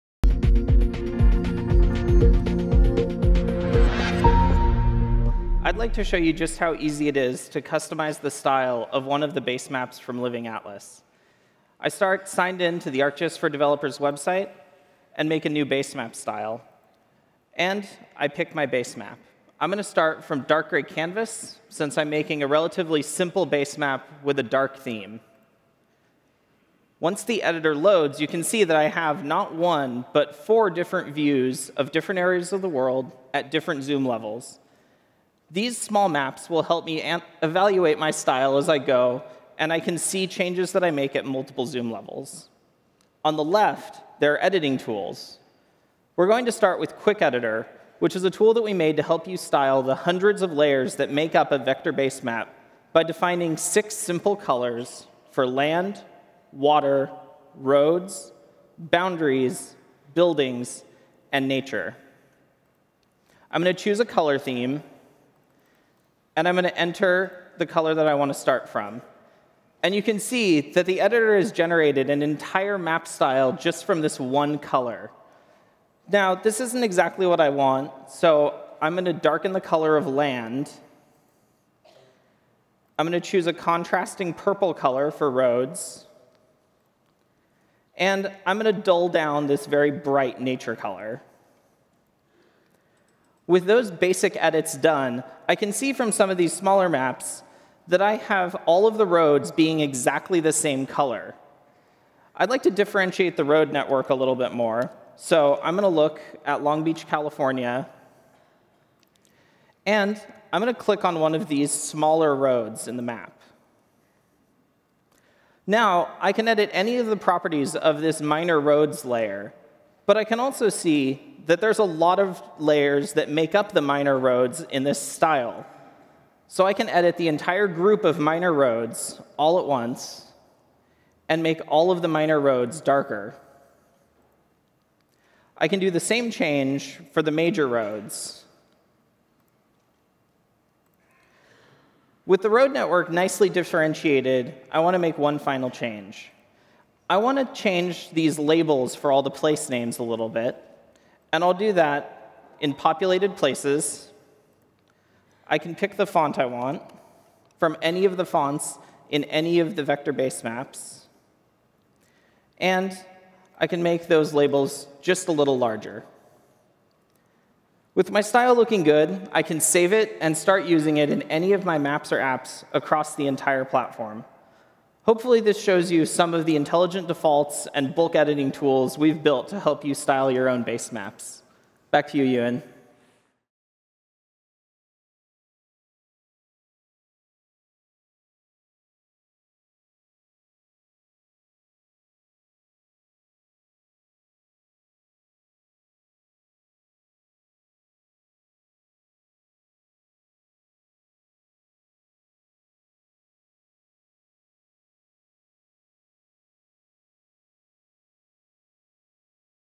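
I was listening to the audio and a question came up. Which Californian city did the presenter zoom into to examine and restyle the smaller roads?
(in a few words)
Long Beach.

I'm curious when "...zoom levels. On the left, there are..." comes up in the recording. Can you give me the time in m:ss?
0:41.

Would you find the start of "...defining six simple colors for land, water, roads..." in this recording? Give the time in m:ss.
0:53.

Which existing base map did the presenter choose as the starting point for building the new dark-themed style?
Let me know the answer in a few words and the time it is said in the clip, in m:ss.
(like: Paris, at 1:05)
Dark gray canvas, at 0:20.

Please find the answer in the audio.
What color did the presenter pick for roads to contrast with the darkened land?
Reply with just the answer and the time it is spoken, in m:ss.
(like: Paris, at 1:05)
Purple, at 1:24.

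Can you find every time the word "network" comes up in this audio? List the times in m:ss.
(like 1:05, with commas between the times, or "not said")
1:43, 2:22.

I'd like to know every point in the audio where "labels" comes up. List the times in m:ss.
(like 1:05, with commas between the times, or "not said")
2:28, 2:44.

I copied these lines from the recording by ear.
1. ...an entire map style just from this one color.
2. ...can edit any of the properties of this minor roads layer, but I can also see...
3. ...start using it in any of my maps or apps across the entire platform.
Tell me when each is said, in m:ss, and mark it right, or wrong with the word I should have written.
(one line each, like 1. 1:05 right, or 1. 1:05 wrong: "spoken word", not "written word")
1. 1:12 right
2. 1:56 right
3. 2:50 right.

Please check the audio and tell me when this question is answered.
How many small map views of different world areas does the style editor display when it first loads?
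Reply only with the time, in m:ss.
0:30.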